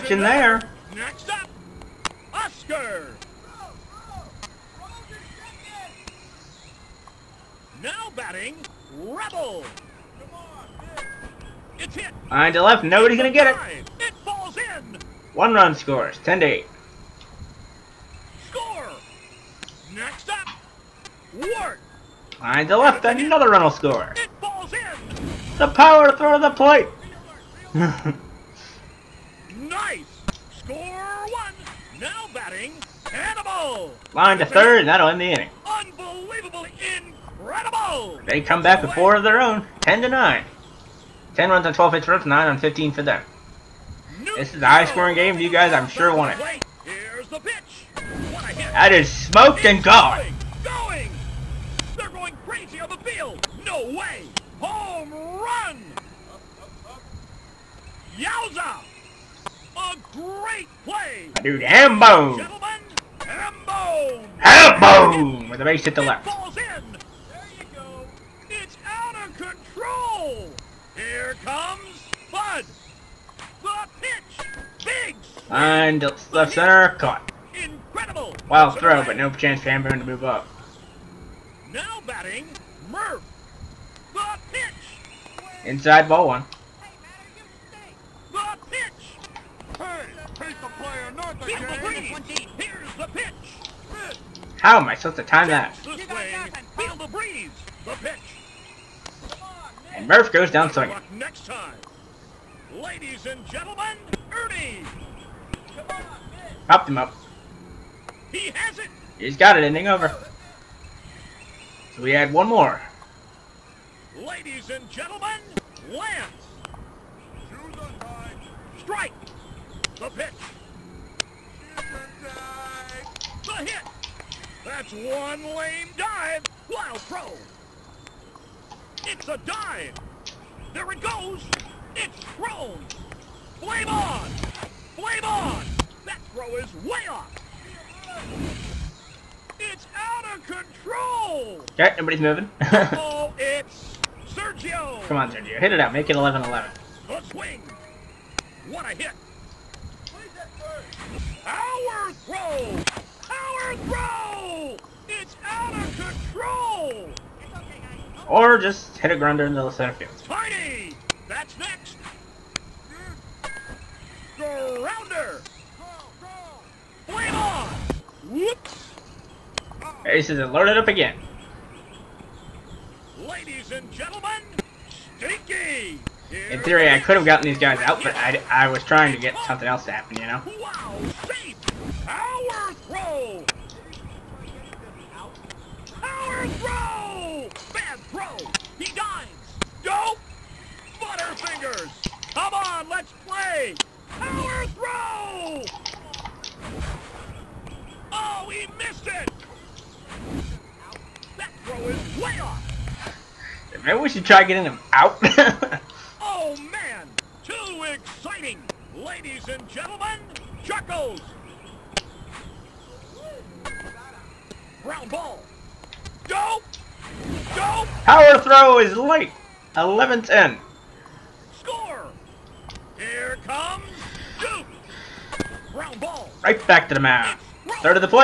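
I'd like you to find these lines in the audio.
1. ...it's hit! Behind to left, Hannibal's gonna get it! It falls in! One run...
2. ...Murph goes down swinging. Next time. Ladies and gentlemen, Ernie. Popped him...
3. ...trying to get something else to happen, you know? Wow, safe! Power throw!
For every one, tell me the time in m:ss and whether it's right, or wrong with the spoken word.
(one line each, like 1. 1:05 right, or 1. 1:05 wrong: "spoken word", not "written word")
1. 0:11 wrong: "Nobody", not "Hannibal"
2. 1:40 right
3. 2:58 right.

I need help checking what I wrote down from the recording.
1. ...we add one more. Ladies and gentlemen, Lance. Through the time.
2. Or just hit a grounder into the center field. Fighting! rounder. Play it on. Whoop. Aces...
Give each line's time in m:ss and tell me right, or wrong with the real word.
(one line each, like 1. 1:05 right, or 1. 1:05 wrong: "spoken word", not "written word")
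1. 1:52 right
2. 2:38 right.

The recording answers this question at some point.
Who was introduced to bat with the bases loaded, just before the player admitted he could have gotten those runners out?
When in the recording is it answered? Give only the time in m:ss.
2:55.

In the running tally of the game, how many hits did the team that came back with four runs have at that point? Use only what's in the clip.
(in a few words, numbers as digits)
15.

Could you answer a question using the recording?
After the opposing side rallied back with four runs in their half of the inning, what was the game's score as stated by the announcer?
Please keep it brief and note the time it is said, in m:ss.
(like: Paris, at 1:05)
10 to 9, at 0:39.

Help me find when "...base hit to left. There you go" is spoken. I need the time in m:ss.
1:05.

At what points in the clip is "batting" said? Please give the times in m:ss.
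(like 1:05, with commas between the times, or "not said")
0:08, 0:32, 1:22.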